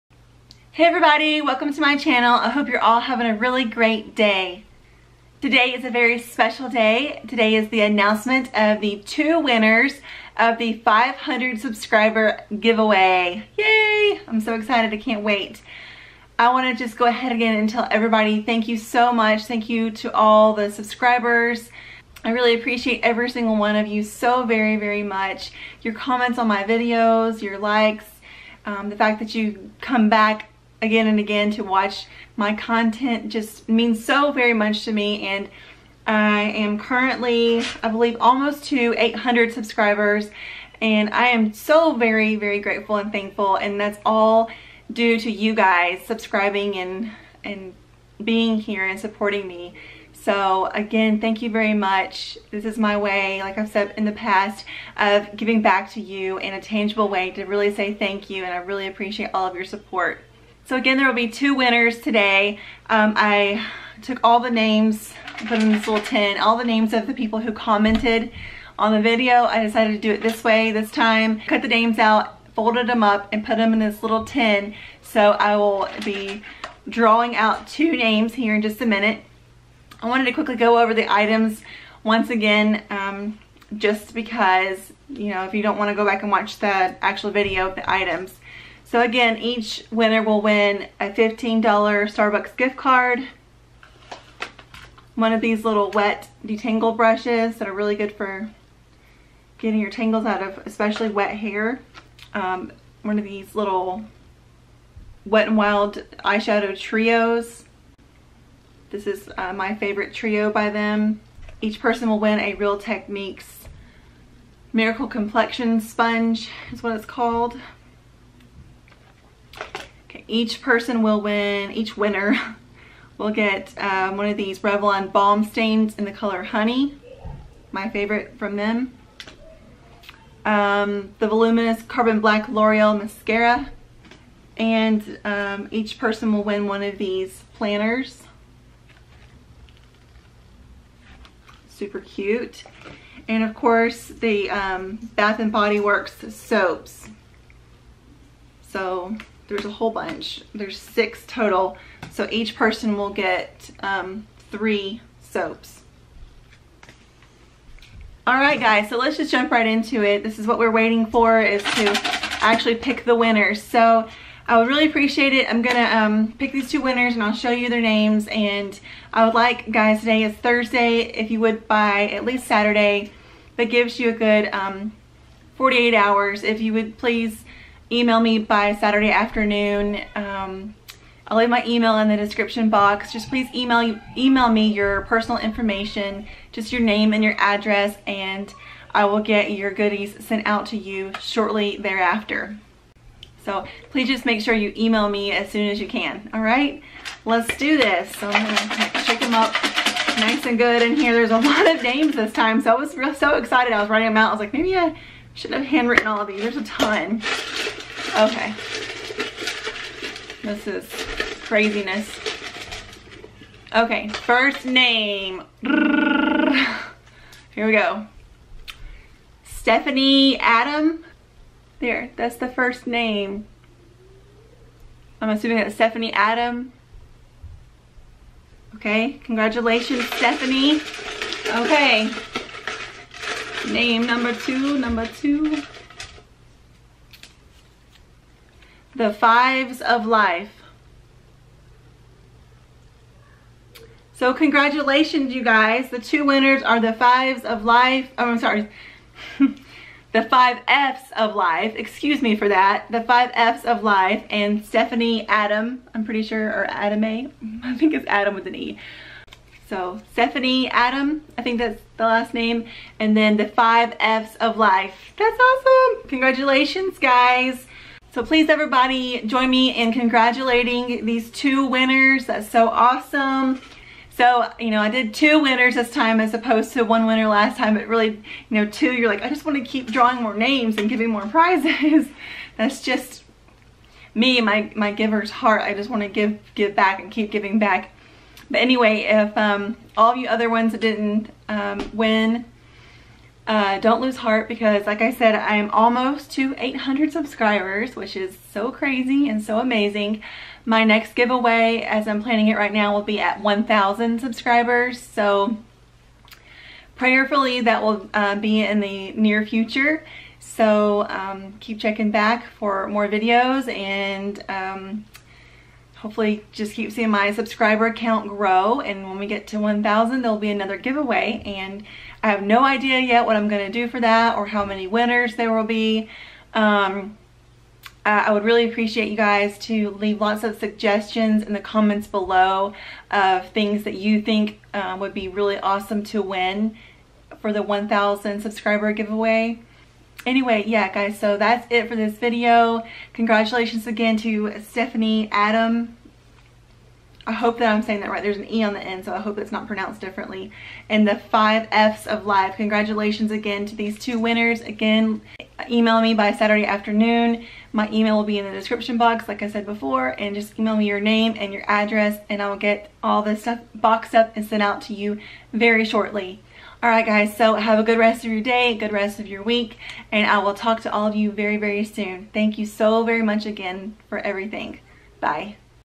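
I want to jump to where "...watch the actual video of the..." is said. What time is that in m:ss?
1:26.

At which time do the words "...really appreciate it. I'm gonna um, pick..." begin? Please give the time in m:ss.
2:44.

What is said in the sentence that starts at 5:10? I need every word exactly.
So um, keep checking back for more videos and um, hopefully just keep seeing my subscriber count grow.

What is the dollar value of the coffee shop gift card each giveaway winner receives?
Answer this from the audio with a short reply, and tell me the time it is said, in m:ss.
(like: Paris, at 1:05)
$15, at 1:31.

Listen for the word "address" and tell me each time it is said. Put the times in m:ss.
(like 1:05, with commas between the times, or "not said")
3:07, 6:01.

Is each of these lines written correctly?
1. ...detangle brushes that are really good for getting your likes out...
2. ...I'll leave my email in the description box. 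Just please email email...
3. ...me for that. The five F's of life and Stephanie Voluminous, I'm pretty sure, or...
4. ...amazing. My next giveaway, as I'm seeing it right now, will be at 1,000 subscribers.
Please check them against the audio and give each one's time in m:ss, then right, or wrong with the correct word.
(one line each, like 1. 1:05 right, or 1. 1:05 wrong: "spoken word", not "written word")
1. 1:36 wrong: "tangles", not "likes"
2. 3:01 right
3. 4:12 wrong: "Adam", not "Voluminous"
4. 4:59 wrong: "planning", not "seeing".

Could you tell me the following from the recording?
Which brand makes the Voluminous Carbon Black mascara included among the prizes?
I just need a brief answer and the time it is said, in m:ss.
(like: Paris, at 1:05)
L'Oreal, at 2:12.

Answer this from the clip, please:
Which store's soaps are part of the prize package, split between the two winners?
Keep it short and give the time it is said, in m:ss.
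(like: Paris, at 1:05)
Bath and Body Works, at 2:25.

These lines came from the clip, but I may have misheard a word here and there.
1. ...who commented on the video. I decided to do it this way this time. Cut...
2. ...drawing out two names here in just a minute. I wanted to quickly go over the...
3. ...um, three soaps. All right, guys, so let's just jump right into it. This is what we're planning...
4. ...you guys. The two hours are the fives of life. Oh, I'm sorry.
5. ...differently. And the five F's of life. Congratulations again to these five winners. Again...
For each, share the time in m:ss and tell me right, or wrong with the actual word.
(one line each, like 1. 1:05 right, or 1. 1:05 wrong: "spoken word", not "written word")
1. 1:07 right
2. 1:16 right
3. 2:33 wrong: "waiting", not "planning"
4. 4:05 wrong: "winners", not "hours"
5. 5:50 wrong: "two", not "five".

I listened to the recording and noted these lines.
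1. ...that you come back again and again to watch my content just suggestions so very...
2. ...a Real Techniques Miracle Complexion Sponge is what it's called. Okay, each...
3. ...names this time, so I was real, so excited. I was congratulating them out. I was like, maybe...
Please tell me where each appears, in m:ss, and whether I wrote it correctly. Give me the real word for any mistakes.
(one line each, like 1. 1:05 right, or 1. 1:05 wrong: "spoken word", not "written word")
1. 0:29 wrong: "means", not "suggestions"
2. 1:52 right
3. 3:21 wrong: "writing", not "congratulating".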